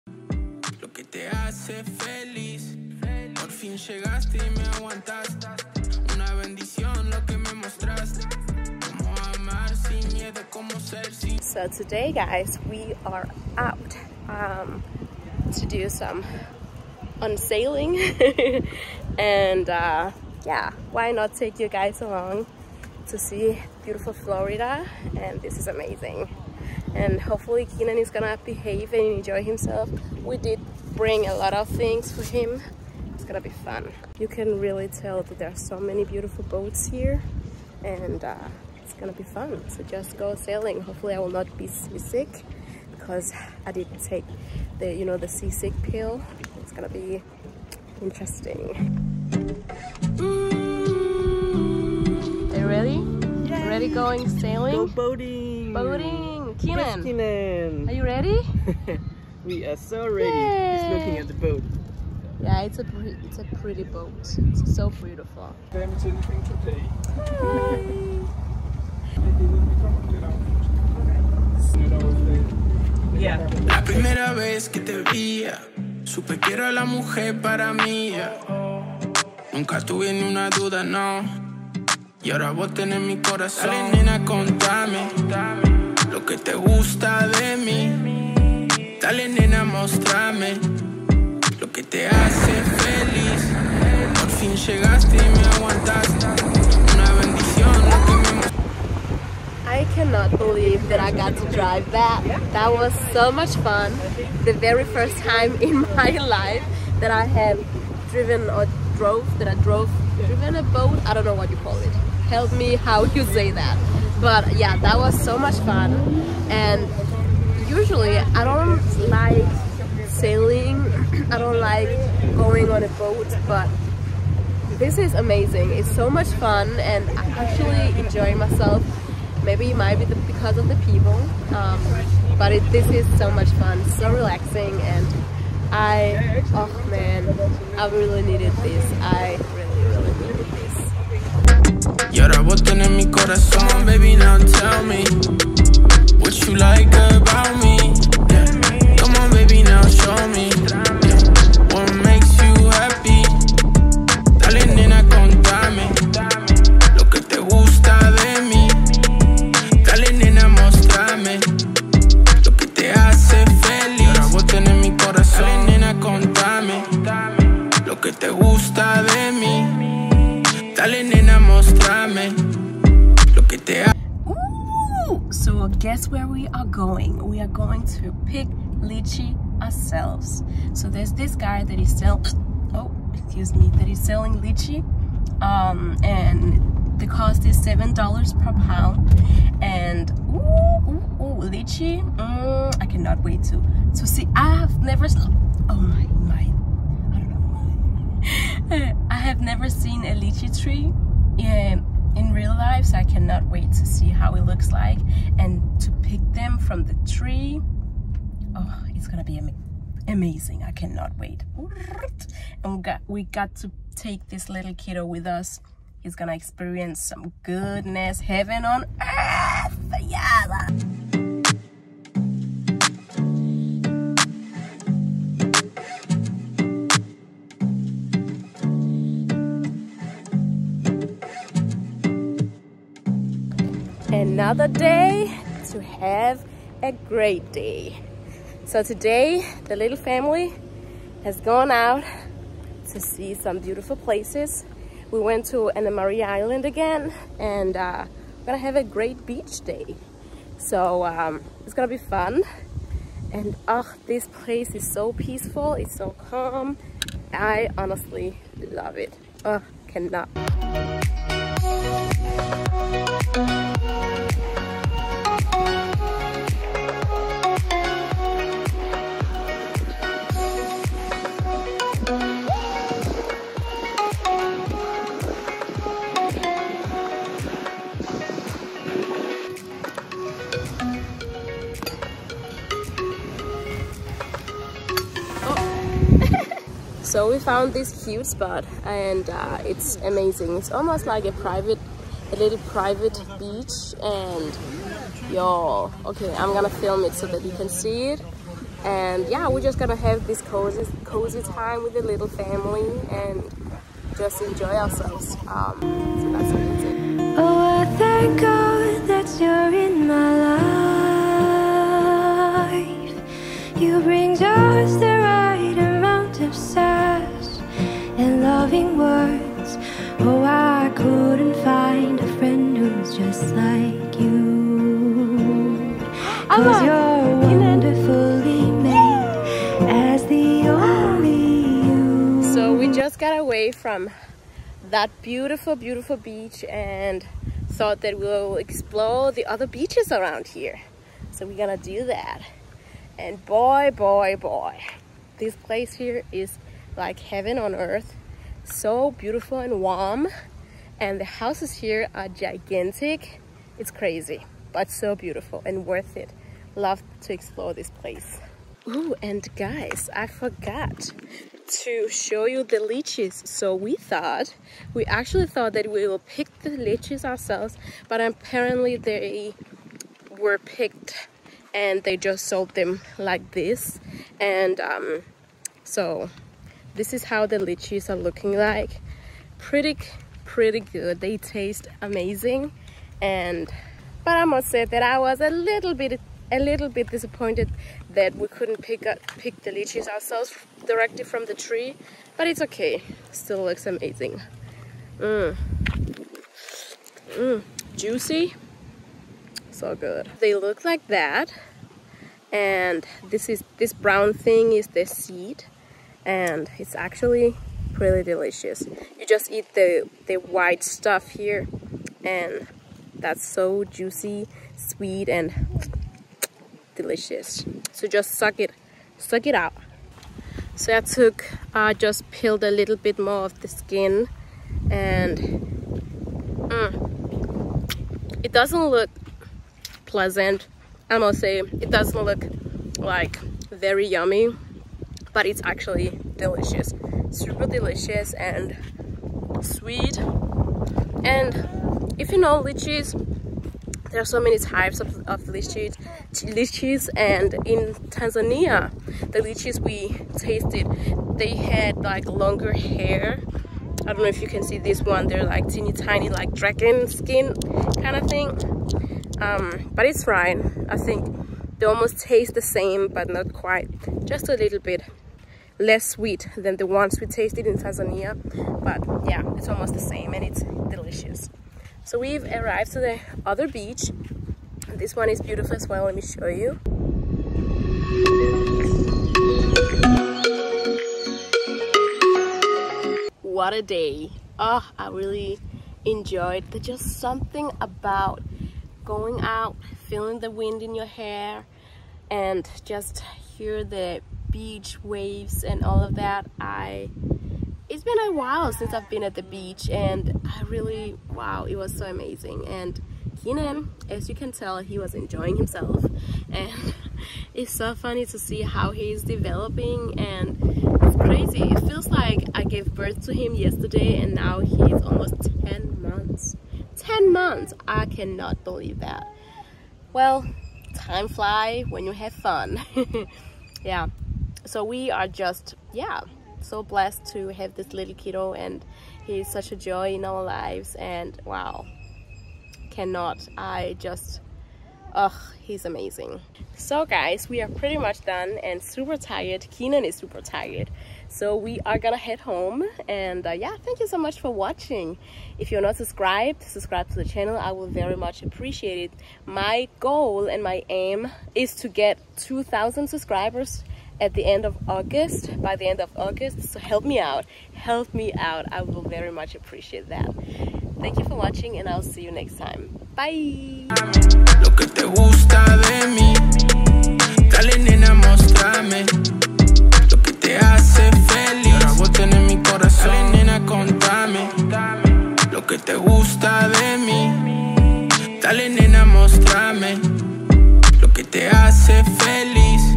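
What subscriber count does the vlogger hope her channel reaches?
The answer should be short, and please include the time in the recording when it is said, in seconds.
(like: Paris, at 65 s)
2,000, at 552 s.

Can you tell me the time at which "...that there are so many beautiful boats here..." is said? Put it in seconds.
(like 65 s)
35 s.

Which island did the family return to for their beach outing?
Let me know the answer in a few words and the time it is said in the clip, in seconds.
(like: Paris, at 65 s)
Anna Maria Island, at 245 s.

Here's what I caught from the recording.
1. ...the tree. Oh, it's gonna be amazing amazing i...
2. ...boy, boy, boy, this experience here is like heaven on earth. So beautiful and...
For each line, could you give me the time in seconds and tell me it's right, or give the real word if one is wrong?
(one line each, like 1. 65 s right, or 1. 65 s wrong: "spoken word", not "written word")
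1. 206 s right
2. 343 s wrong: "place", not "experience".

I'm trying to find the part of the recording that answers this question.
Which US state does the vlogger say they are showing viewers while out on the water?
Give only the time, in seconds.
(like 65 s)
24 s.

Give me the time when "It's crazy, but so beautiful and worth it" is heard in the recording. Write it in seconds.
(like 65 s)
353 s.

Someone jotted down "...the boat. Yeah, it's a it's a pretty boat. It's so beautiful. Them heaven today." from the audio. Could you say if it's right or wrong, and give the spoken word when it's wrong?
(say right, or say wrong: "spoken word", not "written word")
wrong: "children", not "heaven".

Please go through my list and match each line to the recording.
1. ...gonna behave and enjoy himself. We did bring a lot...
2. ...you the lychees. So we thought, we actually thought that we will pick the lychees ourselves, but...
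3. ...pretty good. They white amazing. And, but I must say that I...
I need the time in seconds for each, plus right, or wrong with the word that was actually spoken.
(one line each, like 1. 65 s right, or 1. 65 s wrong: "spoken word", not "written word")
1. 28 s right
2. 362 s right
3. 380 s wrong: "taste", not "white".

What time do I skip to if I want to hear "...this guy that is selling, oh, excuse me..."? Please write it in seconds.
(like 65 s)
181 s.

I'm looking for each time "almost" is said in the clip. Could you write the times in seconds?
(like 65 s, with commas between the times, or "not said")
290 s, 461 s, 469 s, 515 s.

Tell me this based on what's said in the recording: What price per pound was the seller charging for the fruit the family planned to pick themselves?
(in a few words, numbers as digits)
$7.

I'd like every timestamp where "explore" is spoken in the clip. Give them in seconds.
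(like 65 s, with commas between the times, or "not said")
338 s, 357 s.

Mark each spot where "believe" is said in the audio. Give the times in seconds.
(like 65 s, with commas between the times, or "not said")
100 s, 518 s.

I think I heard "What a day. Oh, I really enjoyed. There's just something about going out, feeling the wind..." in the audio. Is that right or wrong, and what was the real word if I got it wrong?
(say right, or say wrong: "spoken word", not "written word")
right.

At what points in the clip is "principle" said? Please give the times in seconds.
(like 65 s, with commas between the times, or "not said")
not said.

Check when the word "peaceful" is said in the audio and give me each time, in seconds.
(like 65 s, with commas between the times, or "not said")
255 s.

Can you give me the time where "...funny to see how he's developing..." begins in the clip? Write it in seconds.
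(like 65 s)
507 s.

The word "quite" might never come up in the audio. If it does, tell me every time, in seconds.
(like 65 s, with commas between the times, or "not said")
463 s.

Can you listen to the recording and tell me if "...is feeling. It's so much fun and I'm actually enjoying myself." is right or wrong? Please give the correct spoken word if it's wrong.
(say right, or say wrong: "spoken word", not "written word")
wrong: "amazing", not "feeling".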